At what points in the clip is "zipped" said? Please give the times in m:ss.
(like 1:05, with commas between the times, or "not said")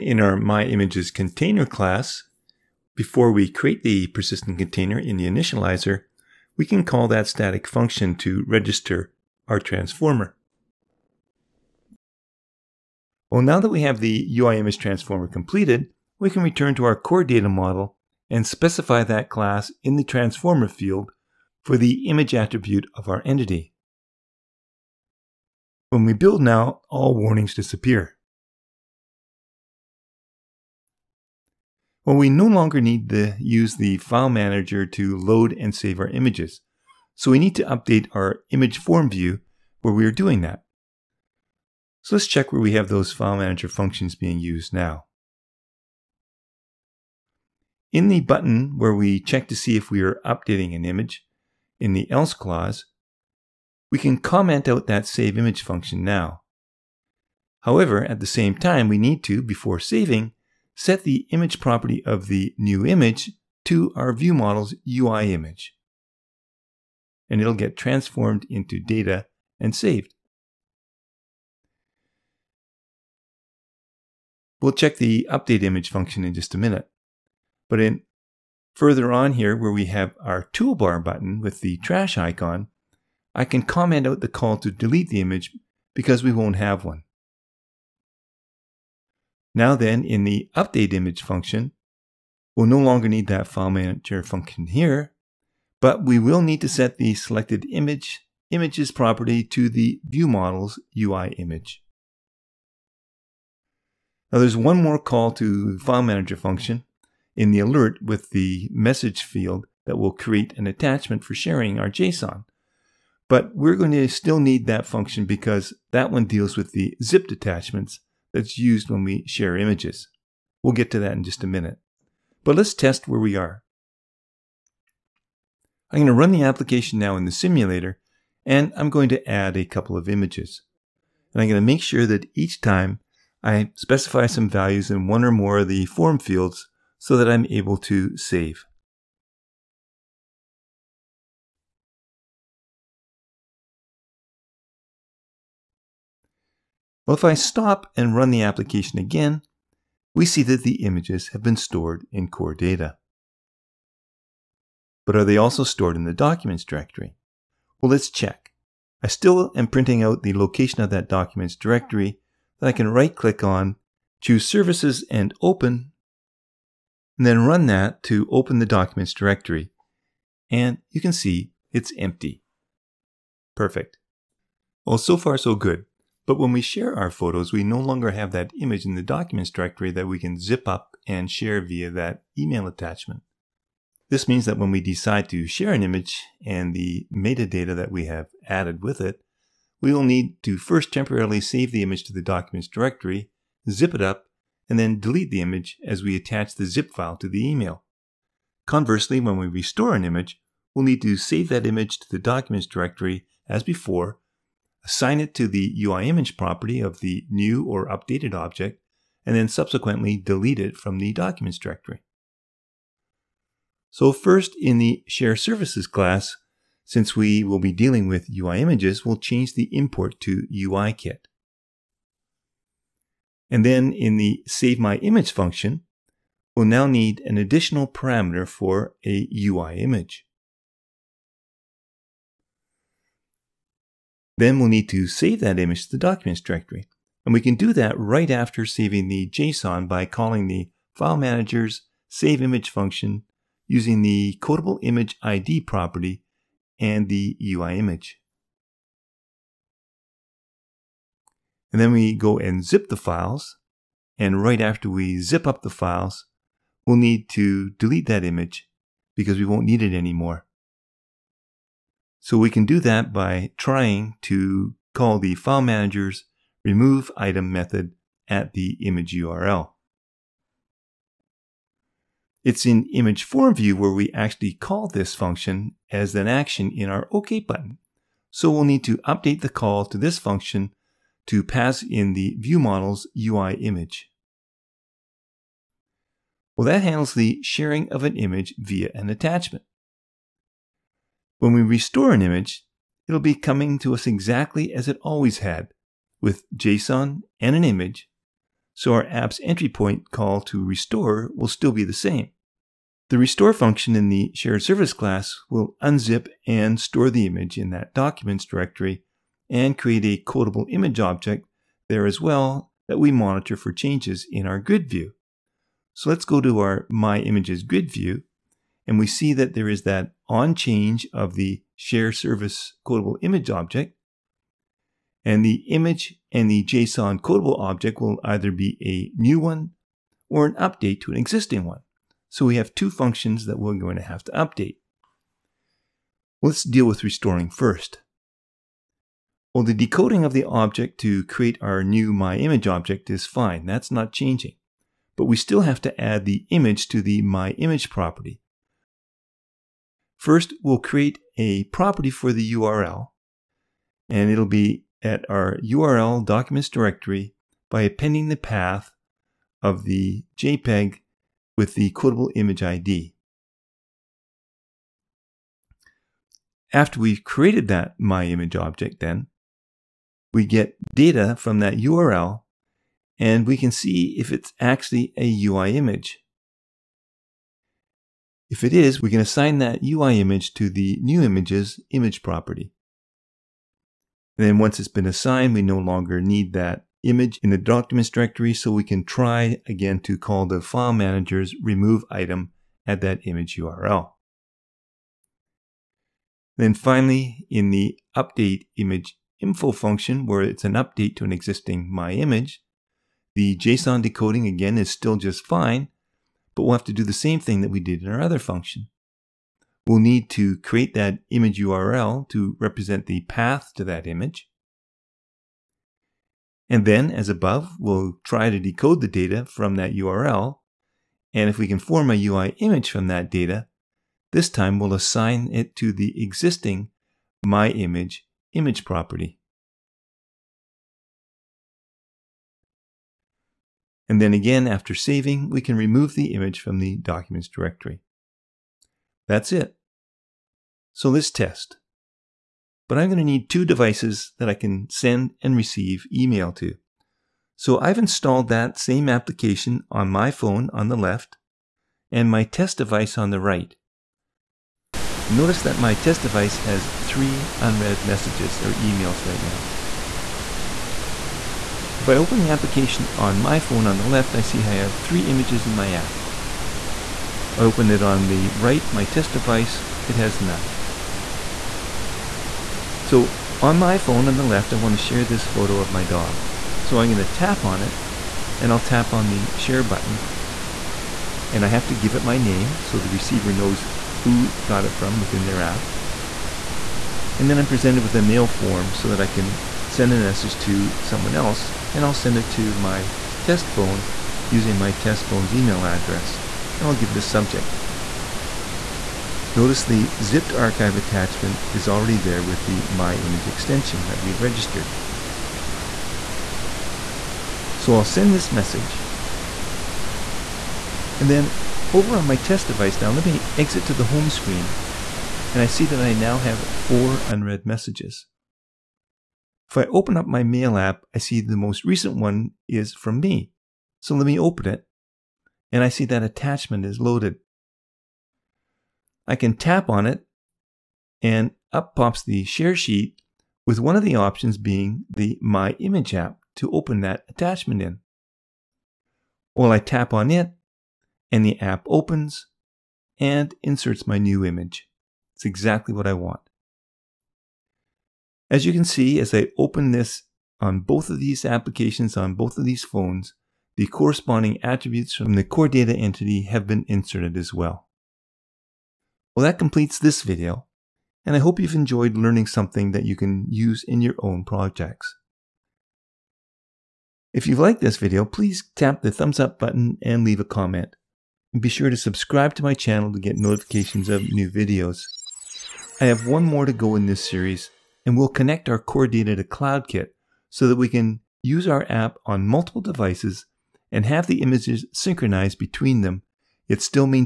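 1:57, 8:20.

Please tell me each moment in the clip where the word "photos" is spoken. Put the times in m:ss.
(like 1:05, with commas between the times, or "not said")
2:57, 7:55.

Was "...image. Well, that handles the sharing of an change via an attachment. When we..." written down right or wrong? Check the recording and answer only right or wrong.
wrong.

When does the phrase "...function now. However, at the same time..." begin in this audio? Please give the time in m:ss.
0:55.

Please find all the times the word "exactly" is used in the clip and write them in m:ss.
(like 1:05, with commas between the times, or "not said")
4:54, 9:05.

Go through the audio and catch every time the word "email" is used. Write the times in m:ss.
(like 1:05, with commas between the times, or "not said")
3:02, 3:17, 7:26, 7:38, 8:15.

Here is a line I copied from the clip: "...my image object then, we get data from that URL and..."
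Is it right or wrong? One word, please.
right.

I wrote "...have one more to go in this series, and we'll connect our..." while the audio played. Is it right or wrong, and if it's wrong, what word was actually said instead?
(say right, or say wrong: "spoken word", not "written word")
right.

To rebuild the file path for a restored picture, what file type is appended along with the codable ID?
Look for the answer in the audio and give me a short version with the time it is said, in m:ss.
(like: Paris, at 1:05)
JPEG, at 6:00.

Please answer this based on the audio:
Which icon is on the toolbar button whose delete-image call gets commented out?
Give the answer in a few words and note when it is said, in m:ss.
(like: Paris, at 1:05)
Trash icon, at 1:21.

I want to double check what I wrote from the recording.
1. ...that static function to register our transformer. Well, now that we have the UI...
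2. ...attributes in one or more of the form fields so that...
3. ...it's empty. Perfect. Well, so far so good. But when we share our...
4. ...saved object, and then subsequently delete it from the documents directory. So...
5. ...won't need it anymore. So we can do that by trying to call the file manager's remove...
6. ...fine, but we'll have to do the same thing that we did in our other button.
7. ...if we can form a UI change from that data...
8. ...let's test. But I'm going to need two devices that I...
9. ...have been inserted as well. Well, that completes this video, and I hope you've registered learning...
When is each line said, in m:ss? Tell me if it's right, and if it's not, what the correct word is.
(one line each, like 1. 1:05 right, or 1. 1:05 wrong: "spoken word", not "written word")
1. 0:07 right
2. 2:14 wrong: "values", not "attributes"
3. 2:51 right
4. 3:27 wrong: "updated", not "saved"
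5. 4:19 right
6. 6:45 wrong: "function", not "button"
7. 7:01 wrong: "image", not "change"
8. 7:21 right
9. 9:16 wrong: "enjoyed", not "registered".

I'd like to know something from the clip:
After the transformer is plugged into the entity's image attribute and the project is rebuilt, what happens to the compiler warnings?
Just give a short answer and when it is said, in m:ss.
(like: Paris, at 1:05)
All warnings disappear, at 0:26.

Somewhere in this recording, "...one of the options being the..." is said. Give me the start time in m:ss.
8:53.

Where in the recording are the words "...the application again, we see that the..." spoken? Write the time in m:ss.
2:28.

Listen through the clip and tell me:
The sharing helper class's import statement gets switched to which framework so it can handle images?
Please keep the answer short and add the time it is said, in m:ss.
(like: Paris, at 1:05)
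UIKit, at 3:40.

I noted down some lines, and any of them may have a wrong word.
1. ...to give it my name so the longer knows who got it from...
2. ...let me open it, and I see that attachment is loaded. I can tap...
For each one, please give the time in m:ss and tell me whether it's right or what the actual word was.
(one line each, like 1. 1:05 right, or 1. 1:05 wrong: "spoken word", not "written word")
1. 8:01 wrong: "receiver", not "longer"
2. 8:44 right.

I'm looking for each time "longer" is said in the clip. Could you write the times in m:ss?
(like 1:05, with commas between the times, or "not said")
0:32, 1:32, 2:57, 6:25.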